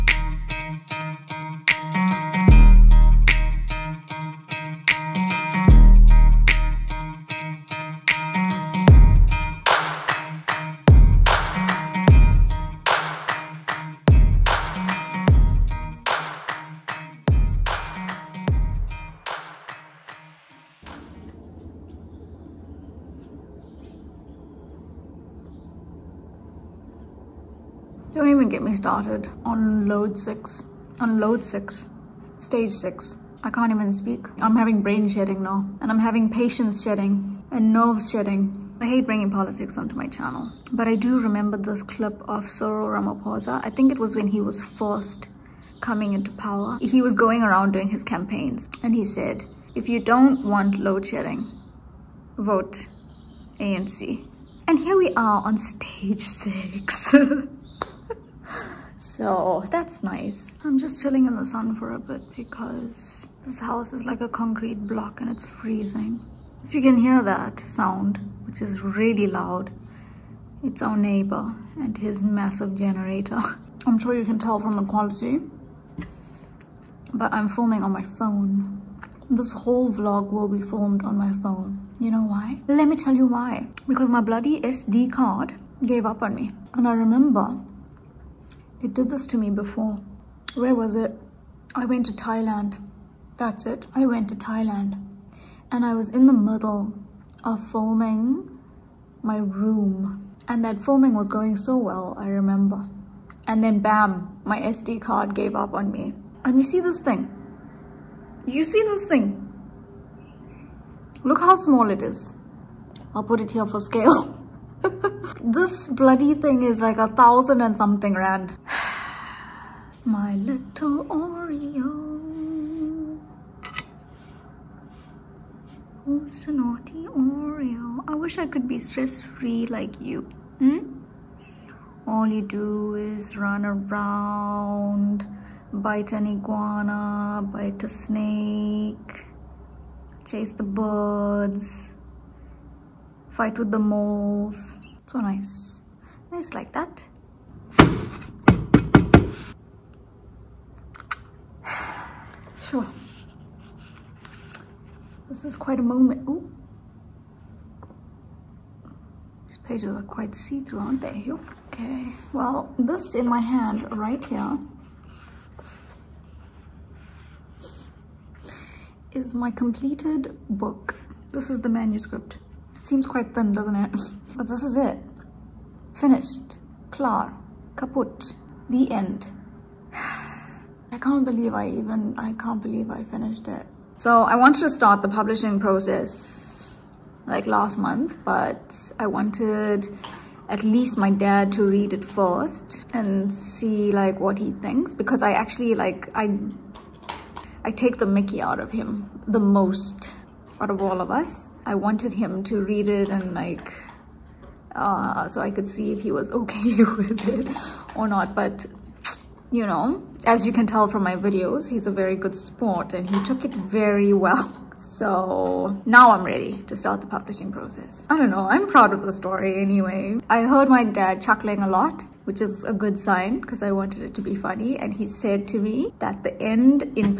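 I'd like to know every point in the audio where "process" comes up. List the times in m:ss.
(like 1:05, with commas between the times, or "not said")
3:05, 3:37.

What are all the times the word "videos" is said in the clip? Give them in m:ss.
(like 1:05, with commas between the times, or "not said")
3:31.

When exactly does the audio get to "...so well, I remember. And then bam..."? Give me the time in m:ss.
1:41.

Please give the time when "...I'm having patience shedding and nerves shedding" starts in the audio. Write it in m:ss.
0:35.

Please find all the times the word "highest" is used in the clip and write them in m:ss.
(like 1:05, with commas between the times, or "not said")
not said.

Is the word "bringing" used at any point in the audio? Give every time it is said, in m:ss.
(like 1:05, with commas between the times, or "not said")
0:39.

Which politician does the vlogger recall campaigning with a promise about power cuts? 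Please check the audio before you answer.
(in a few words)
Cyril Ramaphosa.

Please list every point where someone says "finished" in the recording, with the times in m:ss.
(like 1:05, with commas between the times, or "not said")
2:56, 3:03.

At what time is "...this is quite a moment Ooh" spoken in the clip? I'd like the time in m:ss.
2:35.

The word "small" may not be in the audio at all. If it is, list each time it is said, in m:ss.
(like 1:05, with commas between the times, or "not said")
1:51.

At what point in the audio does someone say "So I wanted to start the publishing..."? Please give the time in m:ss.
3:03.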